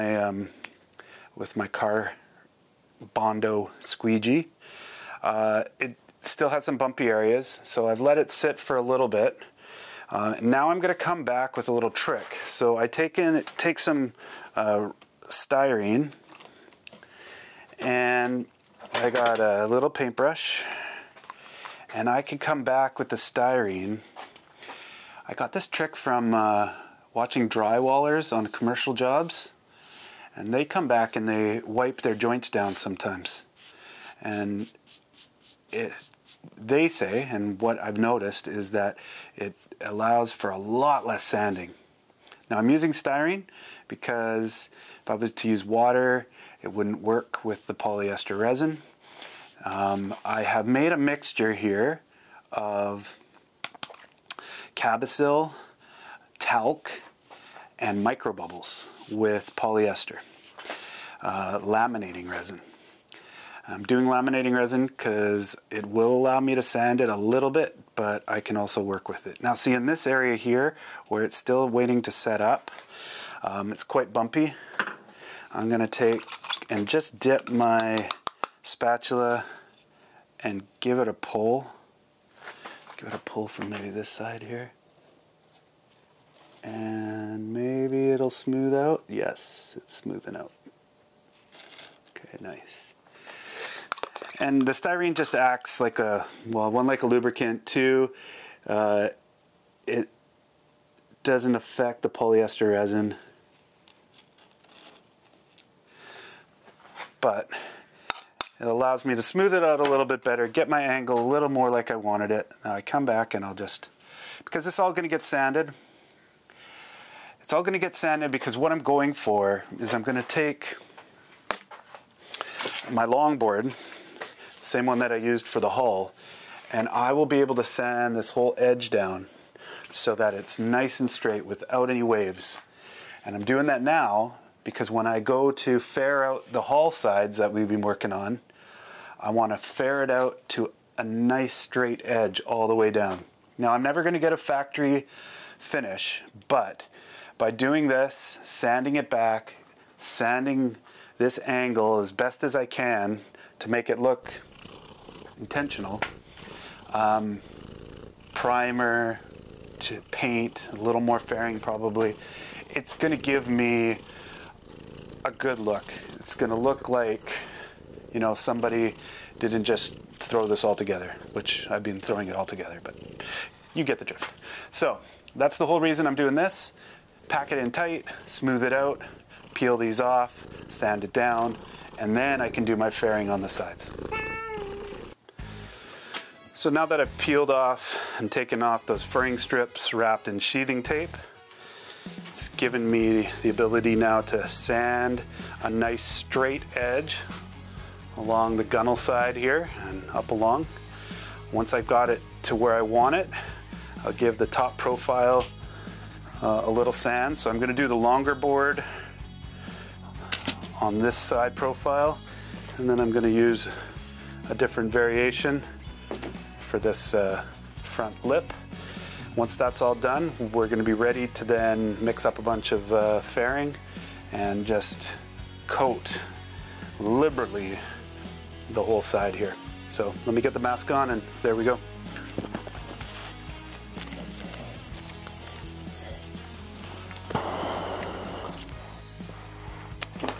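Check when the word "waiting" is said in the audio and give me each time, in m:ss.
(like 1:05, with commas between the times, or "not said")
1:11.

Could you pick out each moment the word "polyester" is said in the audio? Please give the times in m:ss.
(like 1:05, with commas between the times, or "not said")
0:47, 0:59, 1:42.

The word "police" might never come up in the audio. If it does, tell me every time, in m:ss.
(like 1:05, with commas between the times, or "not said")
not said.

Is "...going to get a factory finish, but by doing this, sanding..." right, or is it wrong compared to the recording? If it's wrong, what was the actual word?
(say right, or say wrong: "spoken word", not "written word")
right.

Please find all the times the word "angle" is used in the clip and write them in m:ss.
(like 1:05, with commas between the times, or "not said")
1:50, 2:31.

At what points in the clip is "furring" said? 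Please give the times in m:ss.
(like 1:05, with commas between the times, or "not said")
3:09.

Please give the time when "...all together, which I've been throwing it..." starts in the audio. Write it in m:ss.
2:50.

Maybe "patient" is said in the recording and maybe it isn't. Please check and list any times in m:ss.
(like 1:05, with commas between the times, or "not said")
not said.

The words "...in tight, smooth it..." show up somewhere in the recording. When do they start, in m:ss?
2:57.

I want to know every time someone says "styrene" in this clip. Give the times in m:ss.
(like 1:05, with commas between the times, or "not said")
0:15, 0:23, 0:42, 1:34.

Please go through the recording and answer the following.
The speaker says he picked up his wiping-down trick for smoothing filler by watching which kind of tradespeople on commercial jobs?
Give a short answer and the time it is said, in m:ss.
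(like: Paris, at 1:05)
Drywallers, at 0:27.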